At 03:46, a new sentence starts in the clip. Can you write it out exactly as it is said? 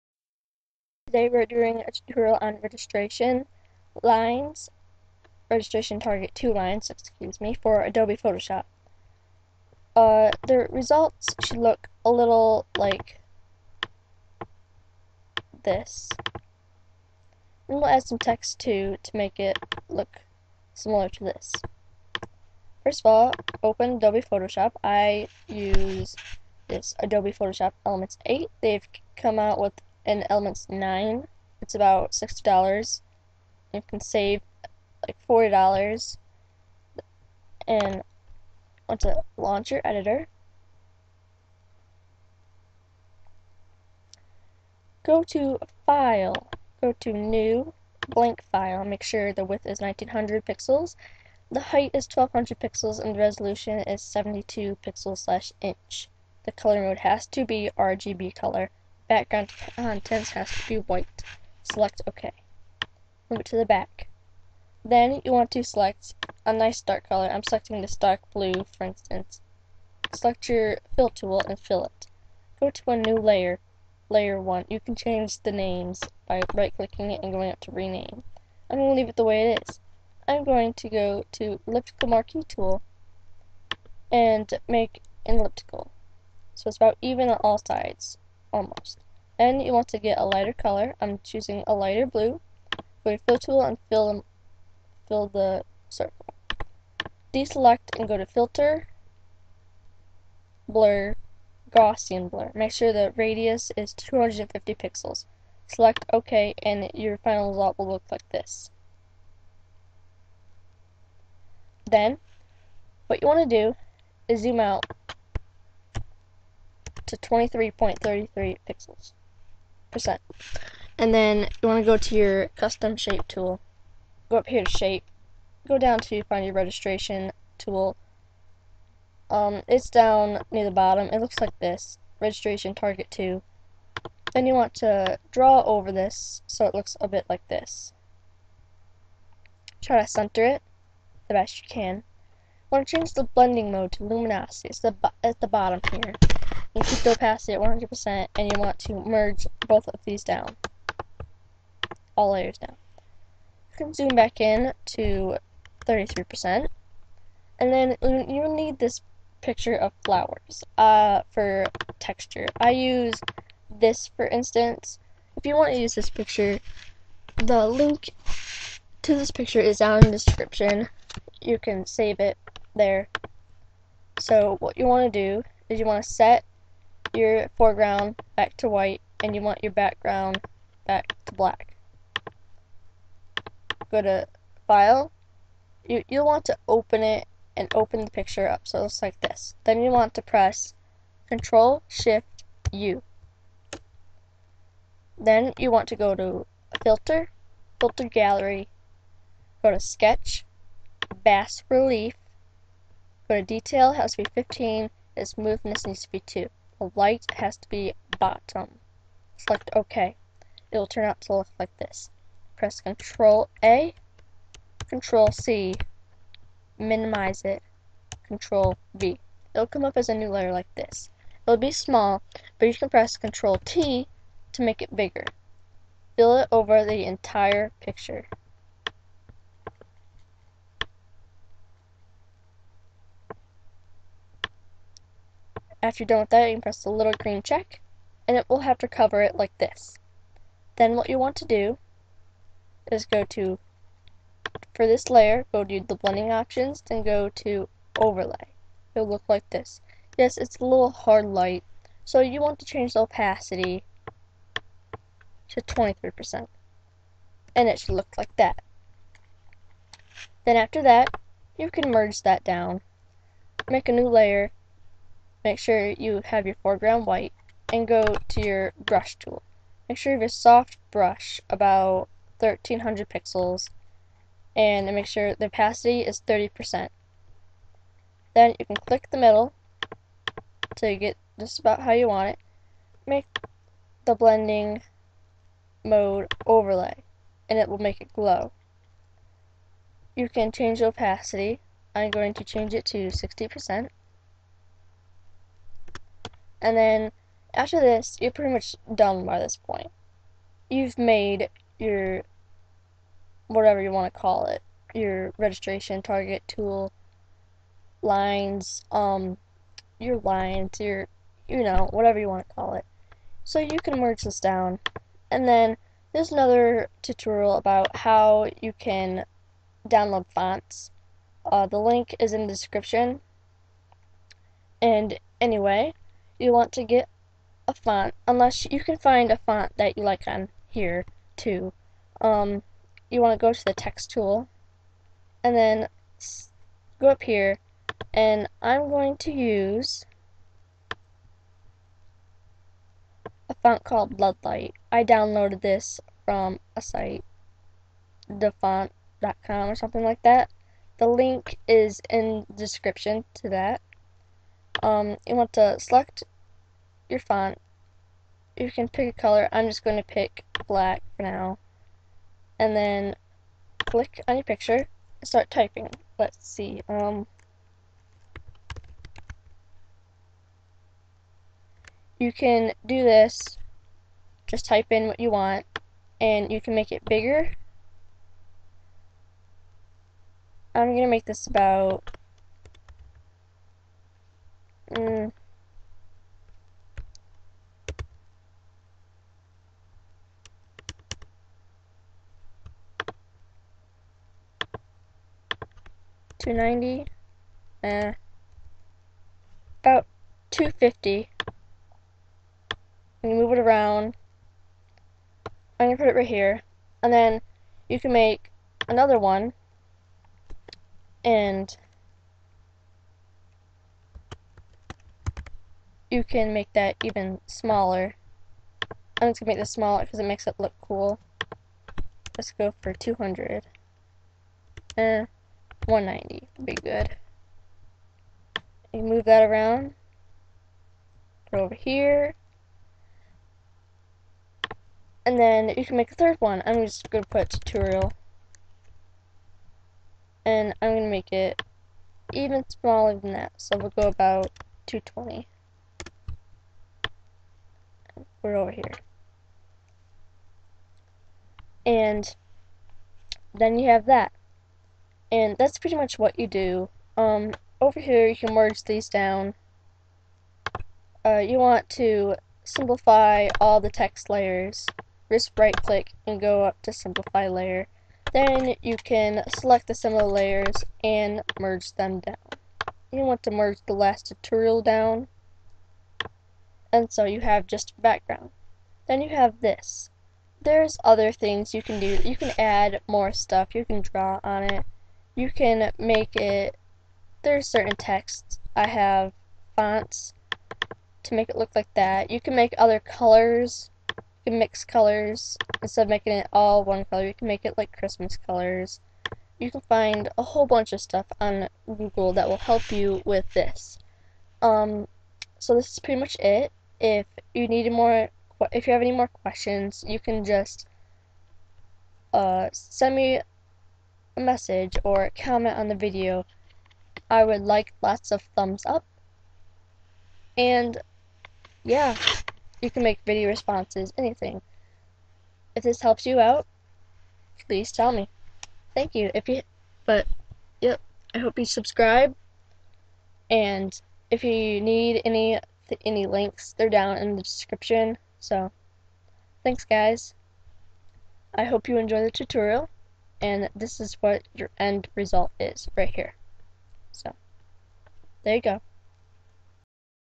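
Fill it over the entire picture.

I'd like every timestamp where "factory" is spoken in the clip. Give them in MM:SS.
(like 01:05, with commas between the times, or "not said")
not said.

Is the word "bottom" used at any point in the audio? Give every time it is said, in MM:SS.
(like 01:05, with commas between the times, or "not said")
02:10, 02:25, 03:28.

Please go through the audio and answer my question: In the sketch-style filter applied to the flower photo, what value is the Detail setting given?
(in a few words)
15.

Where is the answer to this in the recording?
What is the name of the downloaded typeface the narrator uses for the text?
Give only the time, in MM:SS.
05:44.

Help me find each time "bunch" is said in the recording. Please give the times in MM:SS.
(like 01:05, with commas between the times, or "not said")
08:20.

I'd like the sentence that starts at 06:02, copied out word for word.
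And then click on your picture and start typing.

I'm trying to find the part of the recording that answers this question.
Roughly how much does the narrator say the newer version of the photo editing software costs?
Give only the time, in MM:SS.
00:31.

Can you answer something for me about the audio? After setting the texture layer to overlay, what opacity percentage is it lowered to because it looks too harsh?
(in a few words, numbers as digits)
23%.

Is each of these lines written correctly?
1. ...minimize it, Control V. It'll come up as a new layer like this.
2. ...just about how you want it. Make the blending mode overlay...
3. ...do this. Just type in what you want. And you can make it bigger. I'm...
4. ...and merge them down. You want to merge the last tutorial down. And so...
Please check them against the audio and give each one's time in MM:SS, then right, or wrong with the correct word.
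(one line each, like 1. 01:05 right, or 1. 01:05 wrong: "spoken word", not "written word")
1. 03:36 right
2. 04:41 right
3. 06:12 right
4. 07:51 right.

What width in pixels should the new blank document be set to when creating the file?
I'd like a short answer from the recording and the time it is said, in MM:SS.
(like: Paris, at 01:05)
1900 pixels, at 00:49.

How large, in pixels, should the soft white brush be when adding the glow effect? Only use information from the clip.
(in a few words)
1300 pixels.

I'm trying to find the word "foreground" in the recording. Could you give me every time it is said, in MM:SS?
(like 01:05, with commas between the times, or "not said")
02:57, 04:26.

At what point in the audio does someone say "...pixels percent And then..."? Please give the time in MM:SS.
01:58.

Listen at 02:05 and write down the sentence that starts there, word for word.
Go down to find your registration tool.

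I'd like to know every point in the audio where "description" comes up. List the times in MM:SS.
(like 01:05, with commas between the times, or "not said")
02:50, 05:22, 05:52, 08:57.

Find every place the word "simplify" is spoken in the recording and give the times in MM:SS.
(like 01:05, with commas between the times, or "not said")
07:42, 07:46.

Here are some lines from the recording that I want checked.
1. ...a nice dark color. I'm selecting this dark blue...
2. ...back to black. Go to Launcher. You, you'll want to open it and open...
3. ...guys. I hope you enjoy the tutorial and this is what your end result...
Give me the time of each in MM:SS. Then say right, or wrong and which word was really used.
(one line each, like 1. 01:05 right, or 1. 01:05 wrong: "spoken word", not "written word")
1. 01:06 right
2. 03:00 wrong: "File", not "Launcher"
3. 08:59 right.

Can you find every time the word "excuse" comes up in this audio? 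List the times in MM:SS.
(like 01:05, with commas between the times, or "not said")
00:06.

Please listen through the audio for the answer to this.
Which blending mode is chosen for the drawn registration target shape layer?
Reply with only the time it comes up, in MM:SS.
02:24.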